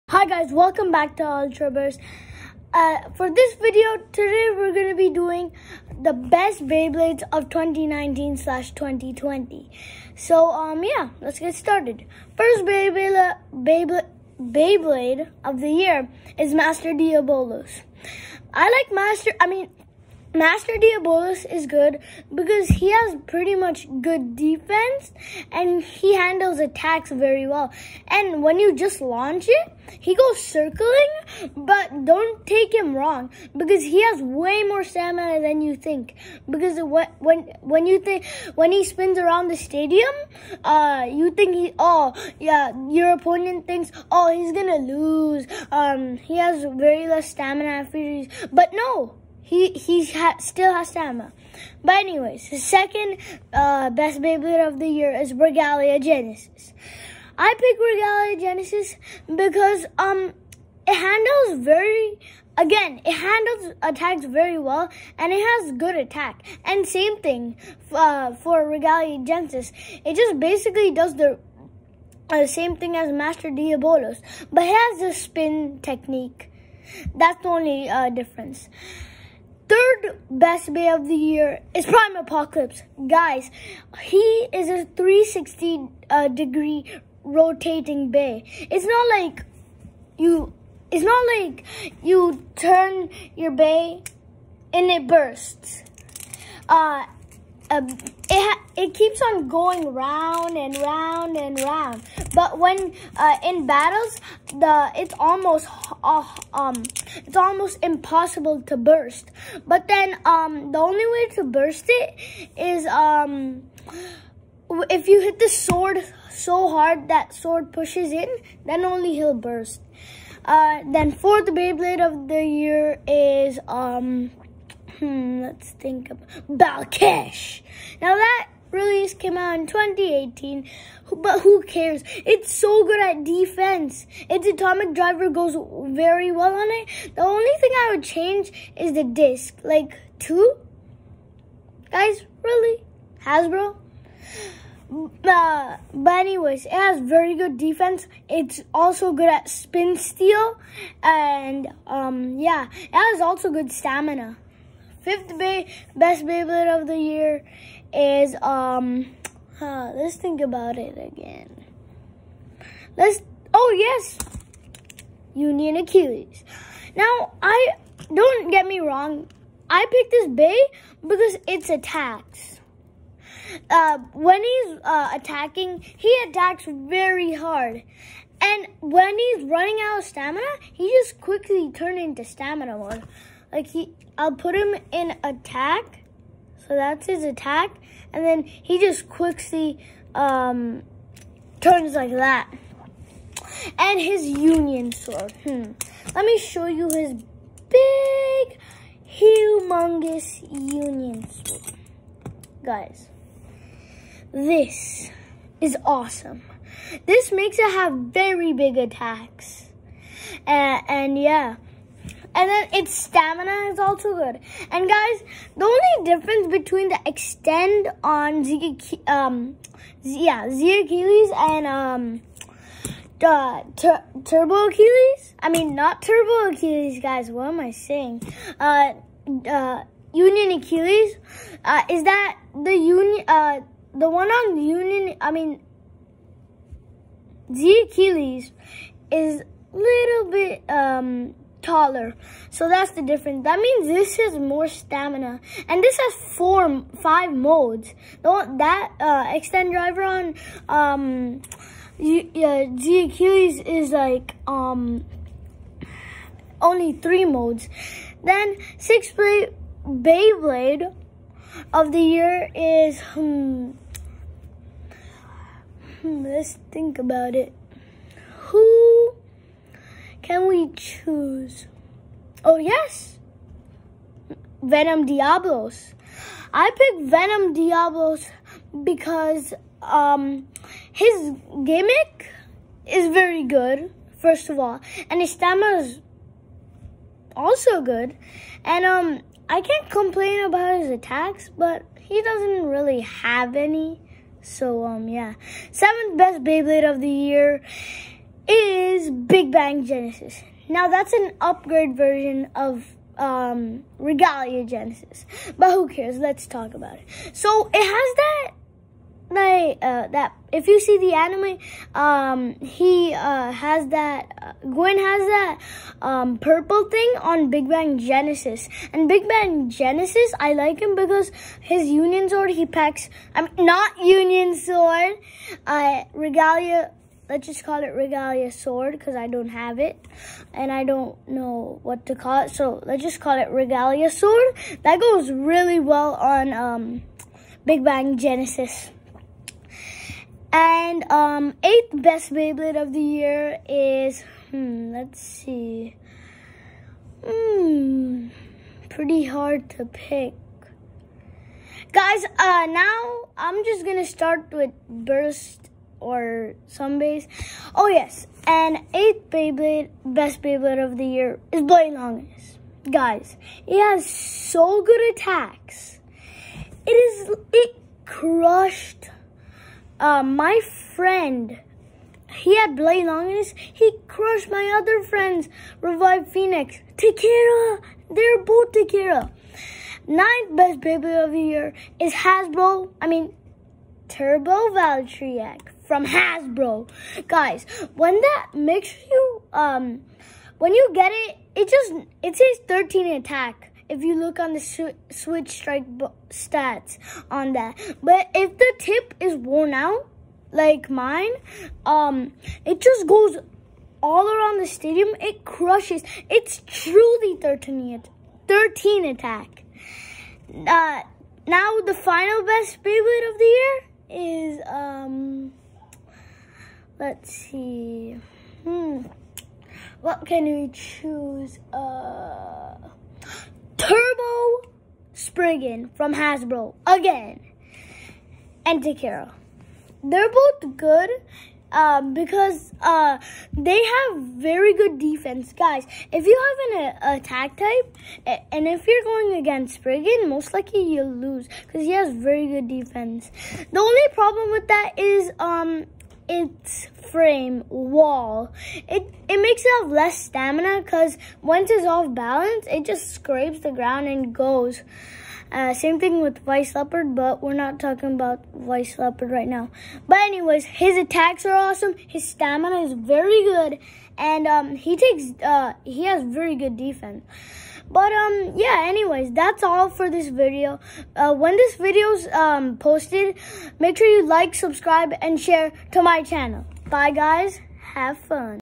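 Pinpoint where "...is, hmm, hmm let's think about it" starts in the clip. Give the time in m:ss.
4:22.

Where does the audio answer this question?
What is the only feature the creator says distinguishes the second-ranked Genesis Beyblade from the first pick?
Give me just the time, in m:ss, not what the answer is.
1:15.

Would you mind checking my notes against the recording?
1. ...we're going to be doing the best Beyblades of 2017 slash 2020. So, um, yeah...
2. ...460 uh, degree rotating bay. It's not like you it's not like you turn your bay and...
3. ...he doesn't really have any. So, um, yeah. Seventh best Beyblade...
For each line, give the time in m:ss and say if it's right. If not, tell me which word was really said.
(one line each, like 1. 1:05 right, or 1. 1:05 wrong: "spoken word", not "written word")
1. 0:04 wrong: "2019", not "2017"
2. 1:24 wrong: "360", not "460"
3. 4:51 right.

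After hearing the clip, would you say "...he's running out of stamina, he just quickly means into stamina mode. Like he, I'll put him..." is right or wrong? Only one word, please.
wrong.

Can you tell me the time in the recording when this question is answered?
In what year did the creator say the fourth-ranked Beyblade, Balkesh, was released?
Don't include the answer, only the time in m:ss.
2:09.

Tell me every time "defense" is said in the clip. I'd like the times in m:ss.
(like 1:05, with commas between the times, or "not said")
0:24, 2:13, 2:27, 7:14, 7:22, 7:46.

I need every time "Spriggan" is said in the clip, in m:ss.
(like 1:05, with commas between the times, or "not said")
7:05, 7:19.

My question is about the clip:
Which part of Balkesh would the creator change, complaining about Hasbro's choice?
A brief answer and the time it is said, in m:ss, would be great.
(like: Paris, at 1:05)
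the disc, at 2:18.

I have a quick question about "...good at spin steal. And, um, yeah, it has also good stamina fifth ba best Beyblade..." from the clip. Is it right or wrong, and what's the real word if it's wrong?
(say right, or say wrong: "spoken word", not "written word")
right.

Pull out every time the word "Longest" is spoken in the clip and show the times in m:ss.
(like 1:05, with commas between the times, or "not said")
6:01, 6:13.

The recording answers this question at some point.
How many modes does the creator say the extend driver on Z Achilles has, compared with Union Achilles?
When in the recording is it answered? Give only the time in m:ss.
4:16.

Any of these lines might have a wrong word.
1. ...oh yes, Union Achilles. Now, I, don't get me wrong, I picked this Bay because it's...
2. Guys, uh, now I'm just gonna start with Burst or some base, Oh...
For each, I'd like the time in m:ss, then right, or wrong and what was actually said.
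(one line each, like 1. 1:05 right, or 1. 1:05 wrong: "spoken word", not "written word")
1. 2:43 right
2. 5:51 right.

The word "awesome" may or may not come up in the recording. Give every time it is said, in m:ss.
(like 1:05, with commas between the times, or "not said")
3:25, 7:41.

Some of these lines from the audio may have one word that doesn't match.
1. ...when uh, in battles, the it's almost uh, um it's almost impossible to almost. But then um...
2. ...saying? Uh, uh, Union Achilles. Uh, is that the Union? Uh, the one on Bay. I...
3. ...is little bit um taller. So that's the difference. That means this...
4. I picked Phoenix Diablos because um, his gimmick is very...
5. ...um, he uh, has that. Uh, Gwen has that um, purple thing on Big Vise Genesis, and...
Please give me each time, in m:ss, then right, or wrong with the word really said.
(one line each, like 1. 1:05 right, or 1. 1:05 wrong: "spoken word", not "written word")
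1. 1:42 wrong: "burst", not "almost"
2. 3:47 wrong: "Union", not "Bay"
3. 3:59 right
4. 4:36 wrong: "Venom", not "Phoenix"
5. 5:11 wrong: "Bang", not "Vise".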